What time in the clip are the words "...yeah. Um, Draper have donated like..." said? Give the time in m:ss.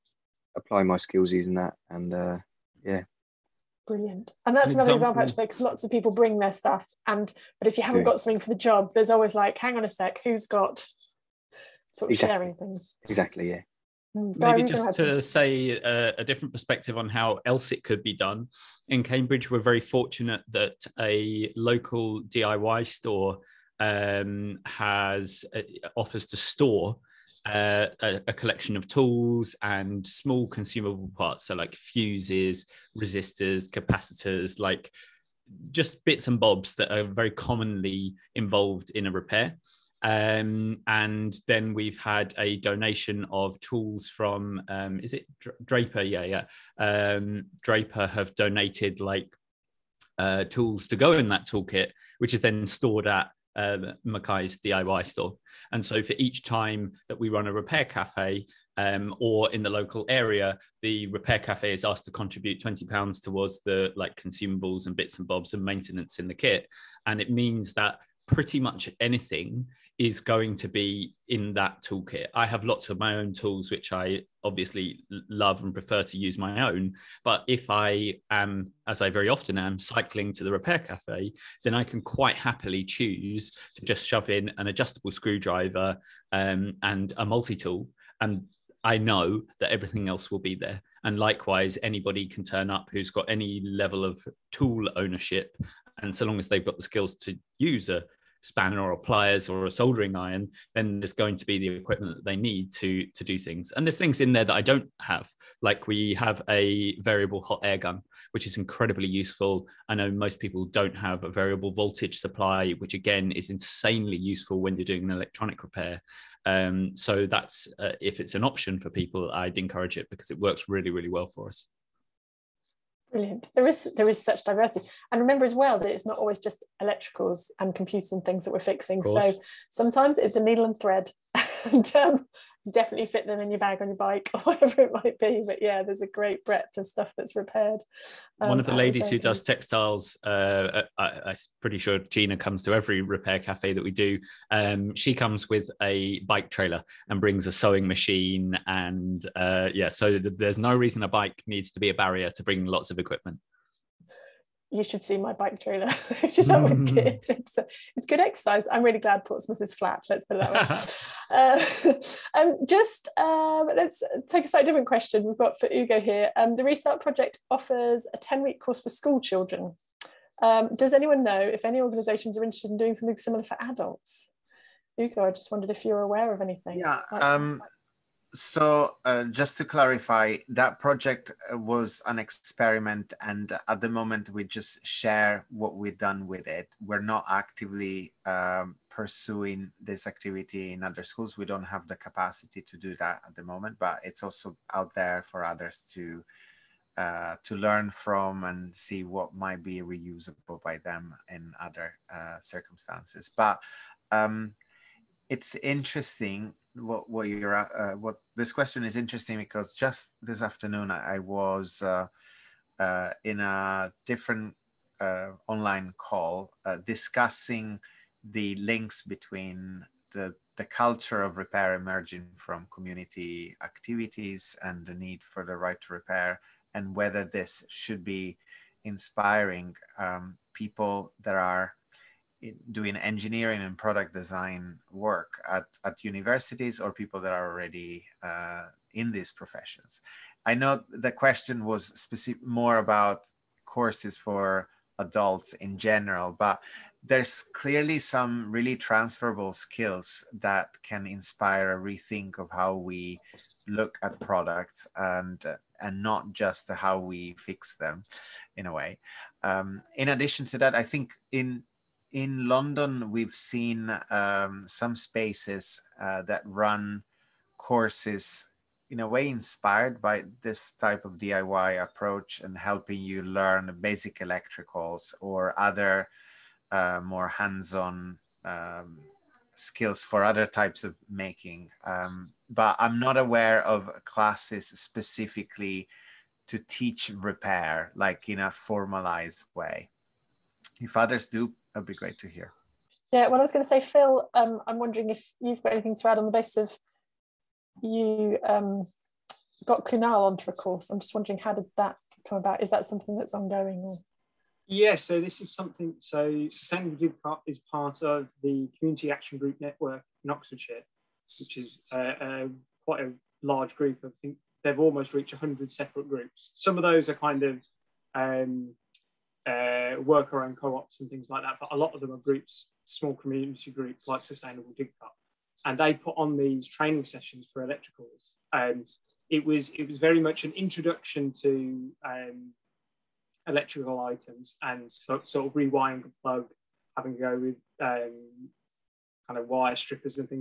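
0:46.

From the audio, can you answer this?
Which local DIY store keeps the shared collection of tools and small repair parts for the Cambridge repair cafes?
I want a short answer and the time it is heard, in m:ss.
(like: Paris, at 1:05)
Mackay's, at 0:54.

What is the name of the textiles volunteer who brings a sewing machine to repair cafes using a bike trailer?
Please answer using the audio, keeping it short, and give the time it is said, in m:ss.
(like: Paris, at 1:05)
Gina, at 2:21.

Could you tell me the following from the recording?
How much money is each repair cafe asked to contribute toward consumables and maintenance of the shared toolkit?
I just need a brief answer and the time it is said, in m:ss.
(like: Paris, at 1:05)
£20, at 1:02.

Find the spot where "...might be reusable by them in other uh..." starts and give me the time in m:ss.
3:19.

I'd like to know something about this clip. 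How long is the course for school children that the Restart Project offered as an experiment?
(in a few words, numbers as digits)
10 weeks.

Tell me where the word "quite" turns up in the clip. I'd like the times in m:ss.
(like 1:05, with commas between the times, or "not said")
1:22, 5:12.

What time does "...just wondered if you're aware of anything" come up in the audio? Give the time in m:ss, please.
2:55.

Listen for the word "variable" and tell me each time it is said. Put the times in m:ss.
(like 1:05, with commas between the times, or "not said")
1:46, 1:51.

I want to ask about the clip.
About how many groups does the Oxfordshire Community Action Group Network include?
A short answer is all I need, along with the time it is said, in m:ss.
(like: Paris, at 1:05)
100, at 5:15.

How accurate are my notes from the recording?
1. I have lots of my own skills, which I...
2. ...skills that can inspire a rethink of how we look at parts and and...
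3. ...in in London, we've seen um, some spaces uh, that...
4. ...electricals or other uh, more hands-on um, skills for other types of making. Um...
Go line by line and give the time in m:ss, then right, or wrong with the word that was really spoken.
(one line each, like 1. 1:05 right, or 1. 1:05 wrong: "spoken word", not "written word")
1. 1:12 wrong: "tools", not "skills"
2. 4:09 wrong: "products", not "parts"
3. 4:21 right
4. 4:34 right.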